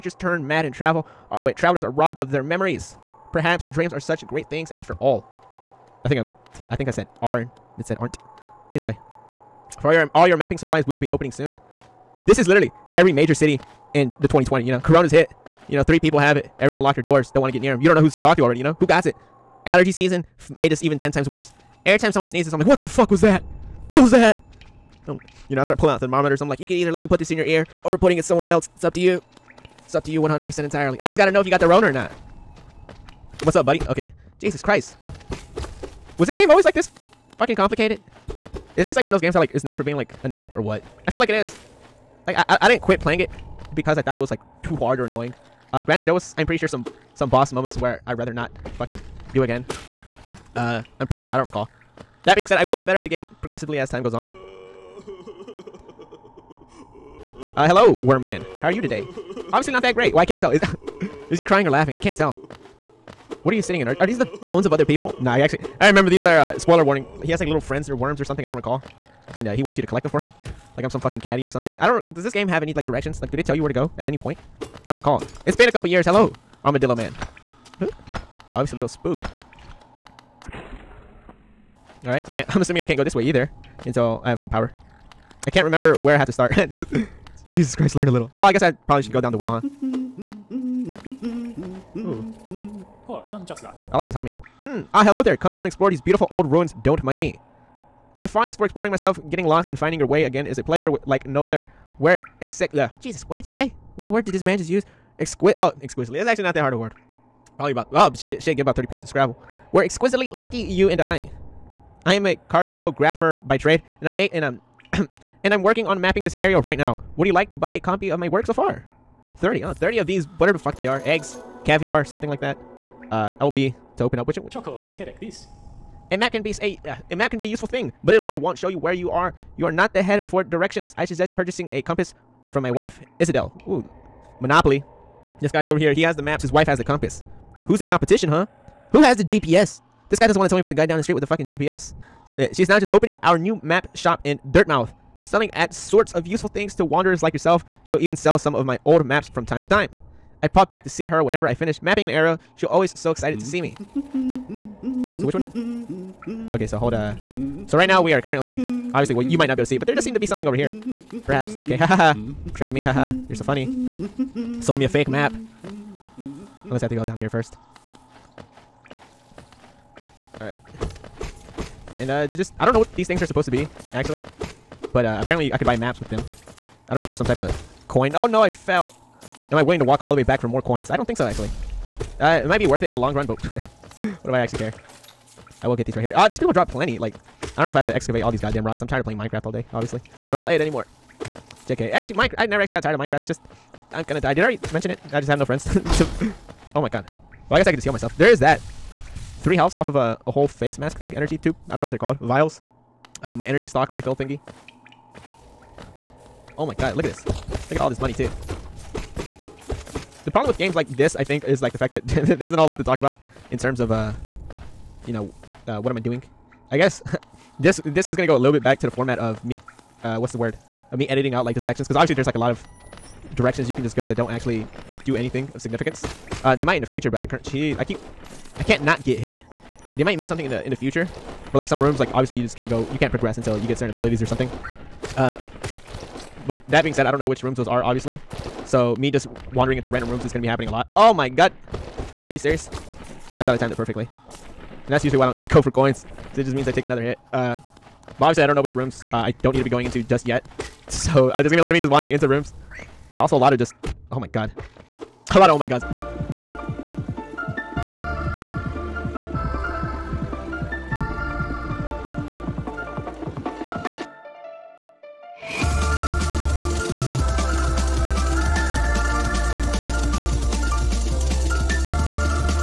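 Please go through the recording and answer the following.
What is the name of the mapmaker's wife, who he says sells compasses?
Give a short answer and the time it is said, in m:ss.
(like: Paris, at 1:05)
Iselda, at 2:13.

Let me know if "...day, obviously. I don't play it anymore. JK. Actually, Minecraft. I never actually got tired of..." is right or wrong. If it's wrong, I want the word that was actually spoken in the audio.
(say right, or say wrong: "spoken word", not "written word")
right.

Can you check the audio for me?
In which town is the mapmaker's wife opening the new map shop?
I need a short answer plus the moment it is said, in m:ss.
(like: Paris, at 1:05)
Dirtmouth, at 2:24.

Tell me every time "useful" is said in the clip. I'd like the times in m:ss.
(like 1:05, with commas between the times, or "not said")
2:07, 2:26.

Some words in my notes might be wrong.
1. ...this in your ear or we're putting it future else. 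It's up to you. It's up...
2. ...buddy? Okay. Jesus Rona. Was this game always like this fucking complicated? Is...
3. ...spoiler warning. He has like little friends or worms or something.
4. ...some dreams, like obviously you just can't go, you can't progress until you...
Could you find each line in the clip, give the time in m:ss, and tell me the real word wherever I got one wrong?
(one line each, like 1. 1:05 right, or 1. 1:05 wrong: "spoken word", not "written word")
1. 0:27 wrong: "somewhere", not "future"
2. 0:33 wrong: "Christ", not "Rona"
3. 1:06 right
4. 3:51 wrong: "rooms", not "dreams".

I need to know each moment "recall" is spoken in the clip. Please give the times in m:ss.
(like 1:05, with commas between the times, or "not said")
0:51, 1:08, 1:14.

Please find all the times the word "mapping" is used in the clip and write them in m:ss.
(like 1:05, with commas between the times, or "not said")
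0:10, 1:56, 2:31.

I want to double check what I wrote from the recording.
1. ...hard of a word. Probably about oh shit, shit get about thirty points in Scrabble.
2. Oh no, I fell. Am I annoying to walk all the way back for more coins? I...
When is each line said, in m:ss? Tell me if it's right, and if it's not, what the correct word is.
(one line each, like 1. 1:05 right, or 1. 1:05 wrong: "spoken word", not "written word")
1. 1:46 right
2. 2:58 wrong: "willing", not "annoying".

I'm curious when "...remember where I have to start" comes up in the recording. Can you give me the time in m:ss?
1:25.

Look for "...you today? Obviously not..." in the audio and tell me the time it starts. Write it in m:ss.
0:58.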